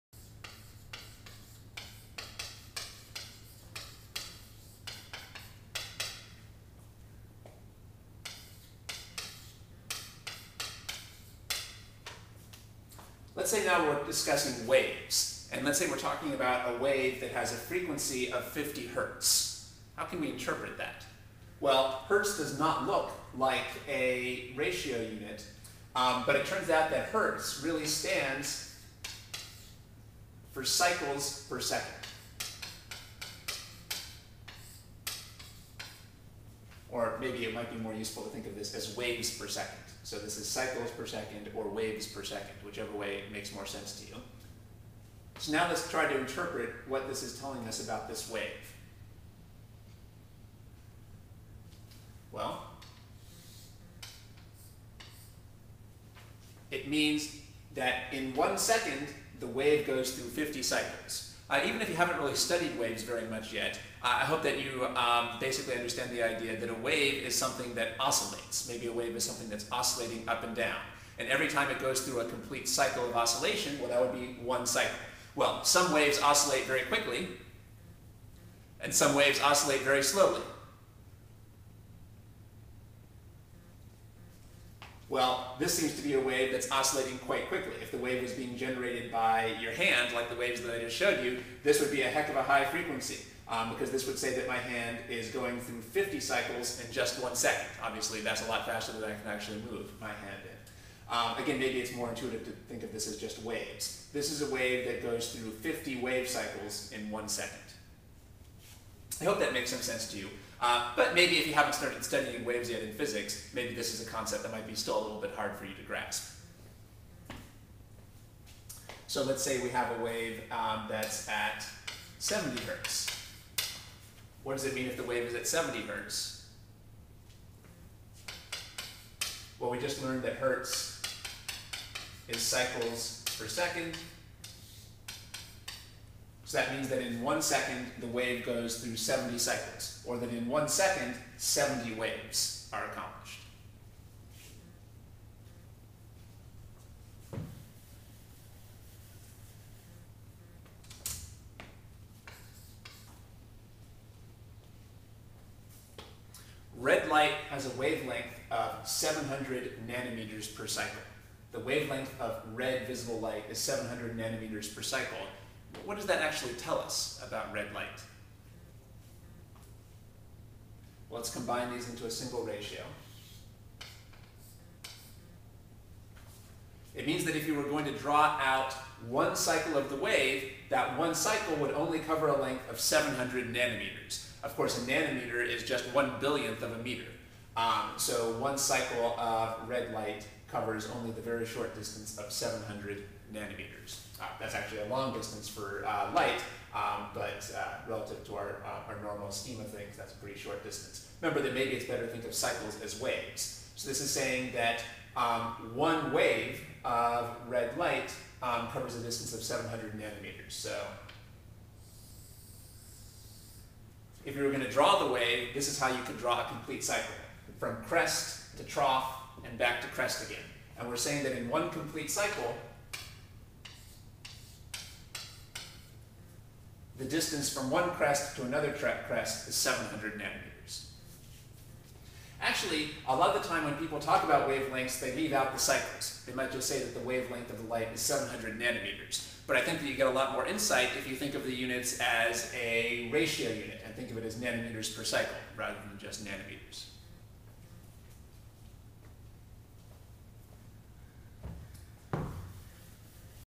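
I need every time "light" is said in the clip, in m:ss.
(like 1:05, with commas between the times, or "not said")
2:37, 2:43, 2:47, 3:09, 3:16, 3:27, 3:57.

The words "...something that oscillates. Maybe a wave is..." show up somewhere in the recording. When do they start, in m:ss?
1:07.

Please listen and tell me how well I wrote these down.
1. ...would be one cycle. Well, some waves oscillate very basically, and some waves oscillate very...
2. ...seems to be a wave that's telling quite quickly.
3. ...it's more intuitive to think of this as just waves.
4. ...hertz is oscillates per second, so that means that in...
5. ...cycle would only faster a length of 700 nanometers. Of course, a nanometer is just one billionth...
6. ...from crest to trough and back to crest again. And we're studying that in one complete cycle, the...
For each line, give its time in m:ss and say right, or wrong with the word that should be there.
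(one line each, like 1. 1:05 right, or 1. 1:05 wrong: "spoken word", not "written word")
1. 1:14 wrong: "quickly", not "basically"
2. 1:25 wrong: "oscillating", not "telling"
3. 1:41 right
4. 2:10 wrong: "cycles", not "oscillates"
5. 3:01 wrong: "cover", not "faster"
6. 3:37 wrong: "saying", not "studying".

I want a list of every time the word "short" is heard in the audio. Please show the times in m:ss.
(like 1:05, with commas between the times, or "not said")
3:11, 3:20.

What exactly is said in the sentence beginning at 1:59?
So let's say we have a wave um, that's at 70 hertz.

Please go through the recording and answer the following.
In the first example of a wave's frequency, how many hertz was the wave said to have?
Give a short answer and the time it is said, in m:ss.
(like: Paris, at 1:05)
50 hertz, at 0:18.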